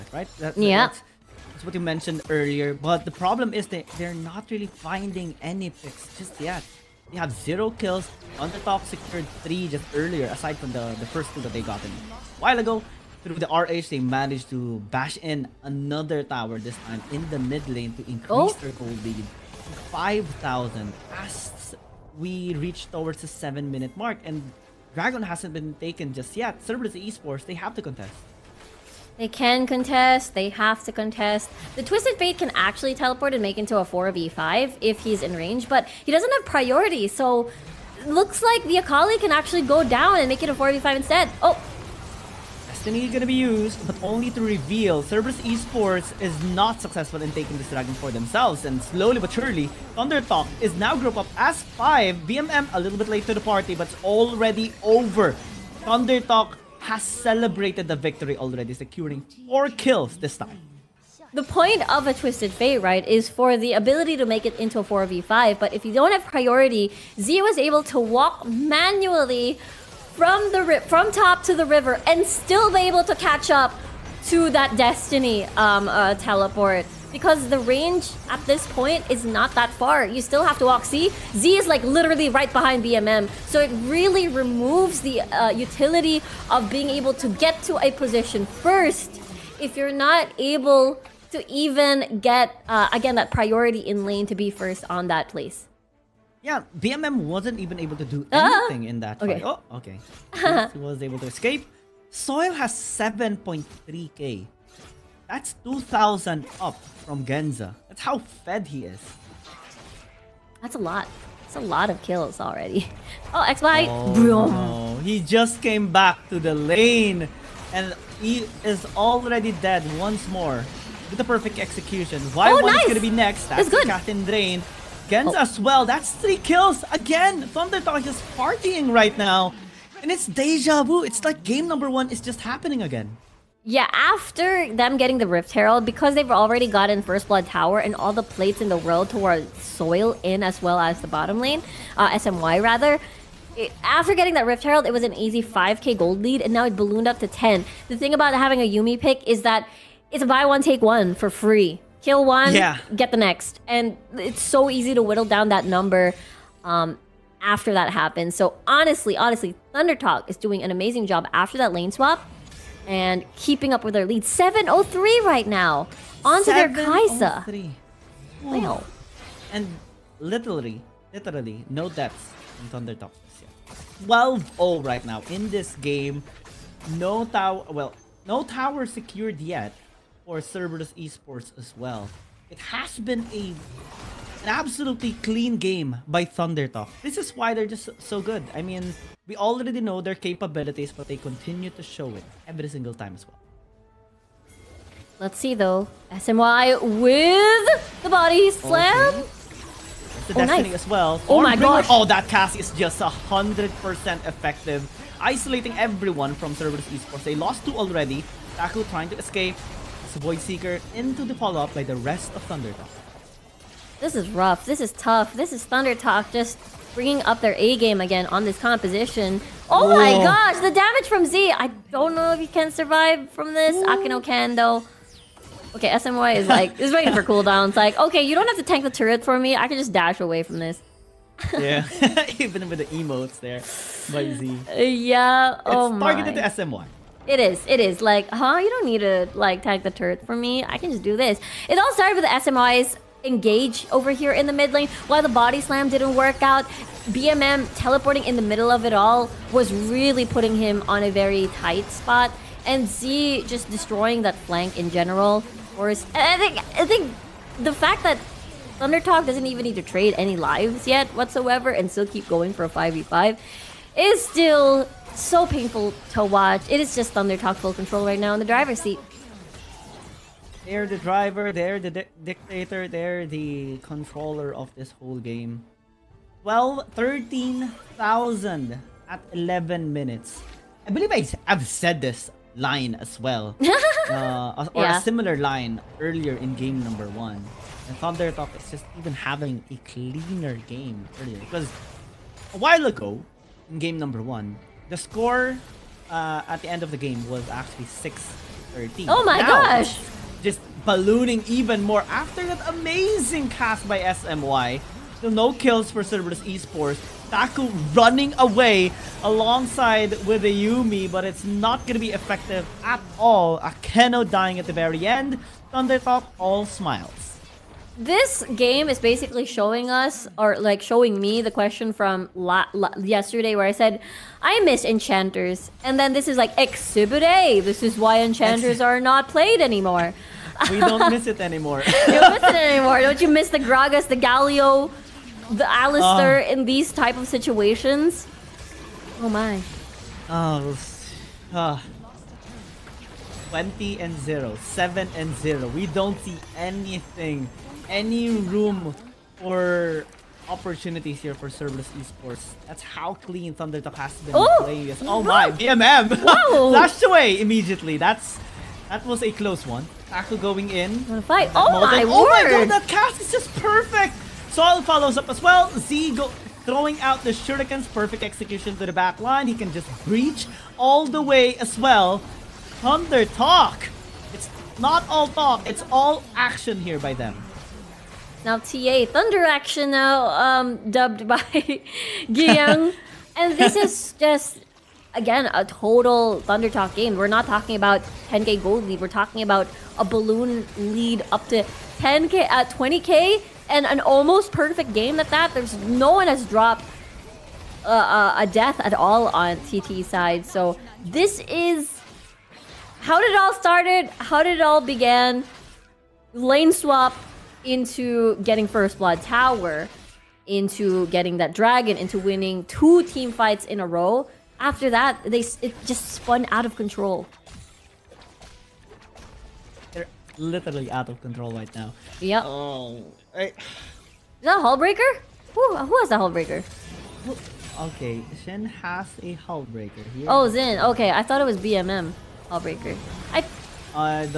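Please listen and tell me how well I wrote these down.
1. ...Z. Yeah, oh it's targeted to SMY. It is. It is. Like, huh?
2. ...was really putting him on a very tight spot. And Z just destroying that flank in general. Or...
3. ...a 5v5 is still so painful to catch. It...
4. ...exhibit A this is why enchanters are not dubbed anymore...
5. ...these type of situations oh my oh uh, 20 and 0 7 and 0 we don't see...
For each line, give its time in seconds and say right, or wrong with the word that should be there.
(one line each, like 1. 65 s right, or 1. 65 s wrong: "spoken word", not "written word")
1. 234 s right
2. 249 s right
3. 262 s wrong: "watch", not "catch"
4. 326 s wrong: "played", not "dubbed"
5. 336 s right.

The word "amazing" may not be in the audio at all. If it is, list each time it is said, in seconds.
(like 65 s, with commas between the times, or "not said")
160 s, 302 s.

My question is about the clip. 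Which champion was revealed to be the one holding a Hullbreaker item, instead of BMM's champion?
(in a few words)
Shen.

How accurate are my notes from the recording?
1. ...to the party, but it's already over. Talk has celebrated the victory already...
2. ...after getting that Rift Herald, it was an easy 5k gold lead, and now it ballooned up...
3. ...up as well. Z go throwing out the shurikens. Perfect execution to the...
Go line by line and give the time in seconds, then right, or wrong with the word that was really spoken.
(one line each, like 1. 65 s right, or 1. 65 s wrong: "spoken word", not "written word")
1. 53 s right
2. 143 s right
3. 365 s right.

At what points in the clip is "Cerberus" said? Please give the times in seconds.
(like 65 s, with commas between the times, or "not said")
26 s, 45 s, 180 s, 206 s, 306 s, 351 s.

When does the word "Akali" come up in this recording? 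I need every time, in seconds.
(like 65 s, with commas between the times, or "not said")
38 s.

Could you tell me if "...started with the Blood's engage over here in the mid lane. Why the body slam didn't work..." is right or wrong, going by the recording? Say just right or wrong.
wrong.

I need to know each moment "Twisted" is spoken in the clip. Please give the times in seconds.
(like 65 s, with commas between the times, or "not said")
31 s, 62 s.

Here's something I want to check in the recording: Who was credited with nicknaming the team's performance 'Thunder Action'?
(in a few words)
Giyang.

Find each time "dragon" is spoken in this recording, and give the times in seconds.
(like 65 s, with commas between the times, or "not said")
24 s, 47 s, 411 s.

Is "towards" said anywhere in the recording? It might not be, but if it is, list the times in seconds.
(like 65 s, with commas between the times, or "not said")
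22 s, 139 s.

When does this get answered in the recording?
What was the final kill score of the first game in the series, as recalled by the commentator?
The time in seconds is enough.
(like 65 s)
297 s.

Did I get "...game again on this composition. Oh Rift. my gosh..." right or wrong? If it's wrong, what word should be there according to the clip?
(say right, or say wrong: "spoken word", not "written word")
wrong: "Whoa", not "Rift".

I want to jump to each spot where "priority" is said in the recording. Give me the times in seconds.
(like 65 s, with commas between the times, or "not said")
36 s, 66 s, 93 s.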